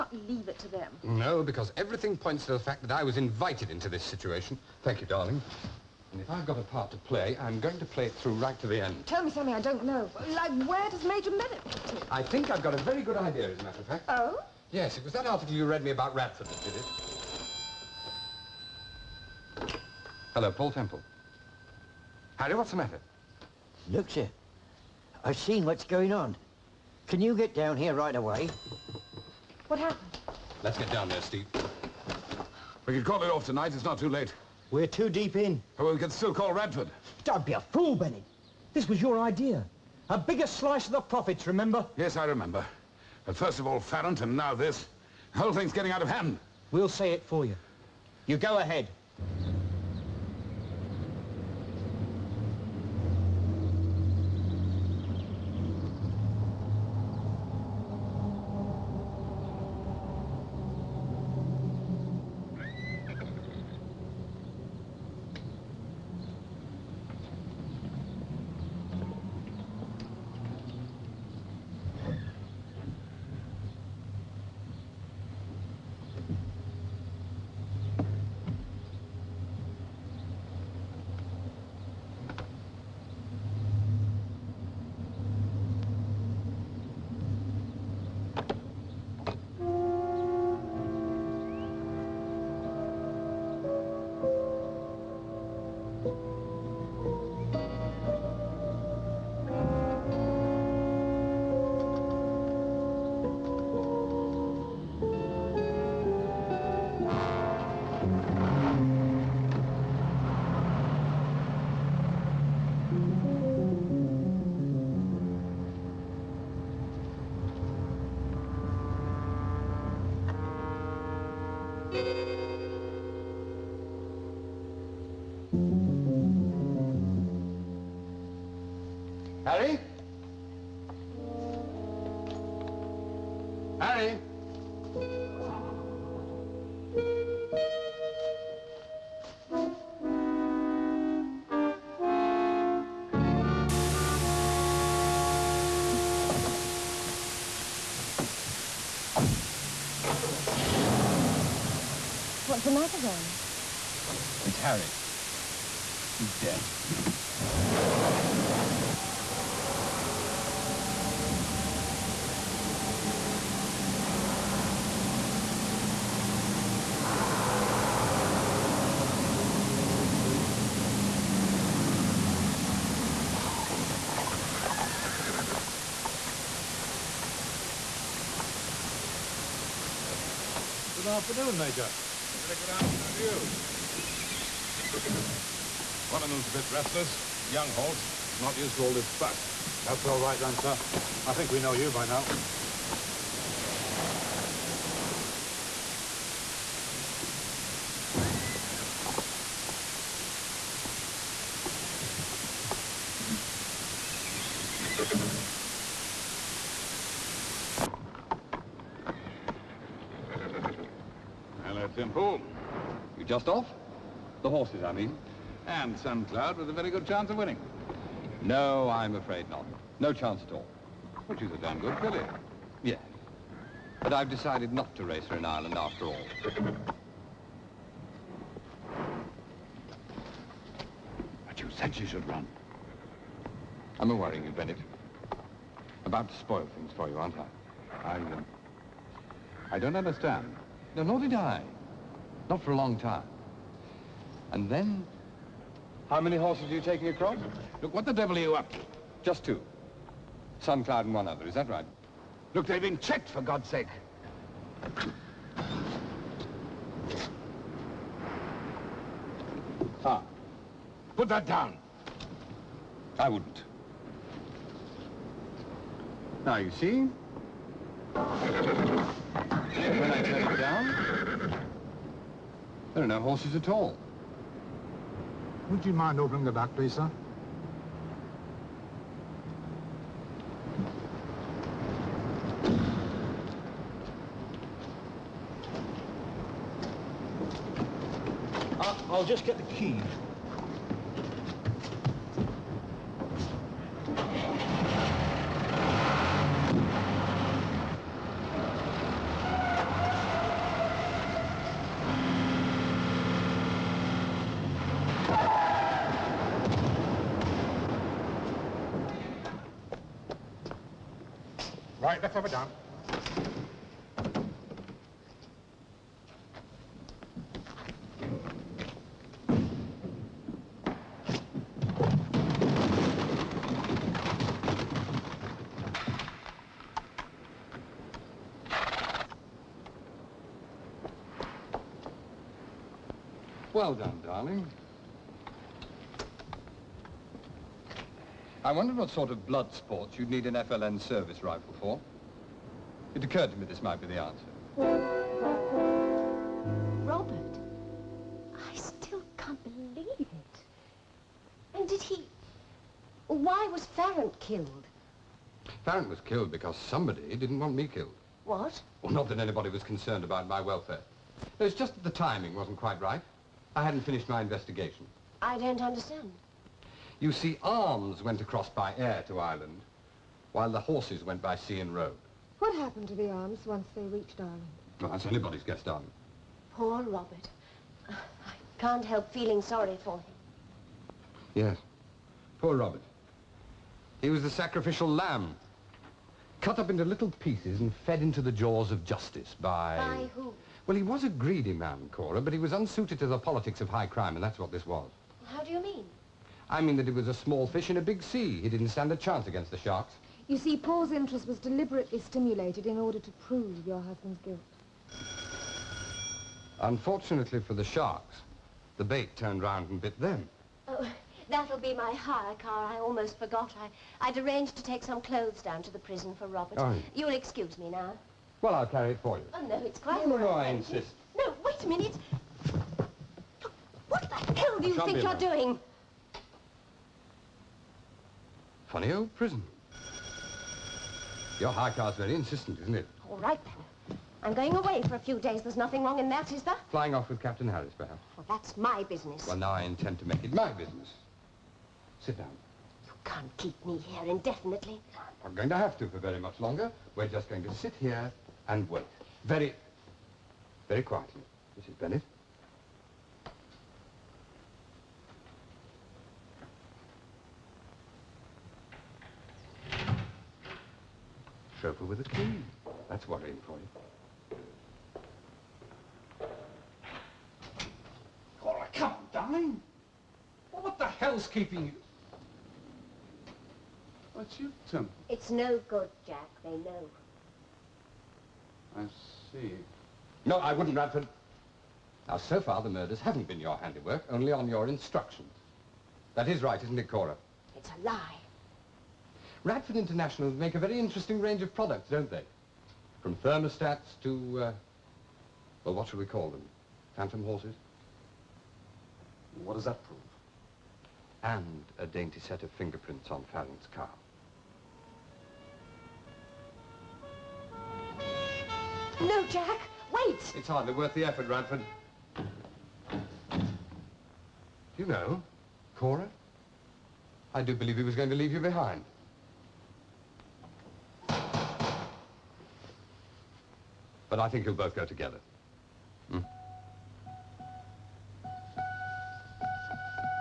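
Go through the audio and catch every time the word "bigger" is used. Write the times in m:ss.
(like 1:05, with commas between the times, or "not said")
0:40.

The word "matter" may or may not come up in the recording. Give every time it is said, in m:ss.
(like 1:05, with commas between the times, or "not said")
0:13, 0:22, 2:32.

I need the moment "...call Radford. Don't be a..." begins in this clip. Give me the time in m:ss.
0:36.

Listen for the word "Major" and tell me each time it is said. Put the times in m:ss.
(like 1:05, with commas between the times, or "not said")
0:11, 3:01.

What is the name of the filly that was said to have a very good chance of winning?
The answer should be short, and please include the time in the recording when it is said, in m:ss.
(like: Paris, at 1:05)
Sun Cloud, at 3:35.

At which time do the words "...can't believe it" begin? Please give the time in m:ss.
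5:49.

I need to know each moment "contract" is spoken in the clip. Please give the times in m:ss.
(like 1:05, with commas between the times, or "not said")
not said.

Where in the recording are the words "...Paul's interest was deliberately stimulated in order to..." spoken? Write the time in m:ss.
6:40.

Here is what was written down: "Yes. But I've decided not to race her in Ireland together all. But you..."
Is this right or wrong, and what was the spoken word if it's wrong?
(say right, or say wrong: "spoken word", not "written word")
wrong: "after", not "together".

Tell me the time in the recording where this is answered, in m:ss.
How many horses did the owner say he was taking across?
4:09.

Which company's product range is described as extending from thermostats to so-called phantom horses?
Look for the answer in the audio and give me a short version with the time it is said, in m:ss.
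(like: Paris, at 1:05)
Radford International, at 8:09.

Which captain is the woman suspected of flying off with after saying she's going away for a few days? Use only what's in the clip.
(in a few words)
Captain Harris.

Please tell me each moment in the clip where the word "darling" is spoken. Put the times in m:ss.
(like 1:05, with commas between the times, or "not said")
0:05, 2:32, 5:34, 6:15, 7:49.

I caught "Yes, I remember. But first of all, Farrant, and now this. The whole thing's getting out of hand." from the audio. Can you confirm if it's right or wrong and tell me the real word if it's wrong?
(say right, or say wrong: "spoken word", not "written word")
right.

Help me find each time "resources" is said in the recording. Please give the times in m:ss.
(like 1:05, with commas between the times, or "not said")
not said.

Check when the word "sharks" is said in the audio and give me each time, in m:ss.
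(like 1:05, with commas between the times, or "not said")
6:39, 6:47.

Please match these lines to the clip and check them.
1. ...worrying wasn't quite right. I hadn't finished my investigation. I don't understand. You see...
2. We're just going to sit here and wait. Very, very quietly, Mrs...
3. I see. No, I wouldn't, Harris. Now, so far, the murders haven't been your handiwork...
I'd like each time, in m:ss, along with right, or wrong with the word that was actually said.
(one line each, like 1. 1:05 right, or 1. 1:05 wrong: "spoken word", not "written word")
1. 6:02 wrong: "timing", not "worrying"
2. 7:27 right
3. 7:58 wrong: "Radford", not "Harris".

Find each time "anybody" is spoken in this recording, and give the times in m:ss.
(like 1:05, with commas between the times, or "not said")
5:59, 6:15.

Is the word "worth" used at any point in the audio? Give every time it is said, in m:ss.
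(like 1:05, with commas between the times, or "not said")
8:30.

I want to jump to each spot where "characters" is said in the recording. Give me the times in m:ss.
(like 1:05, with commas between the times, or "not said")
not said.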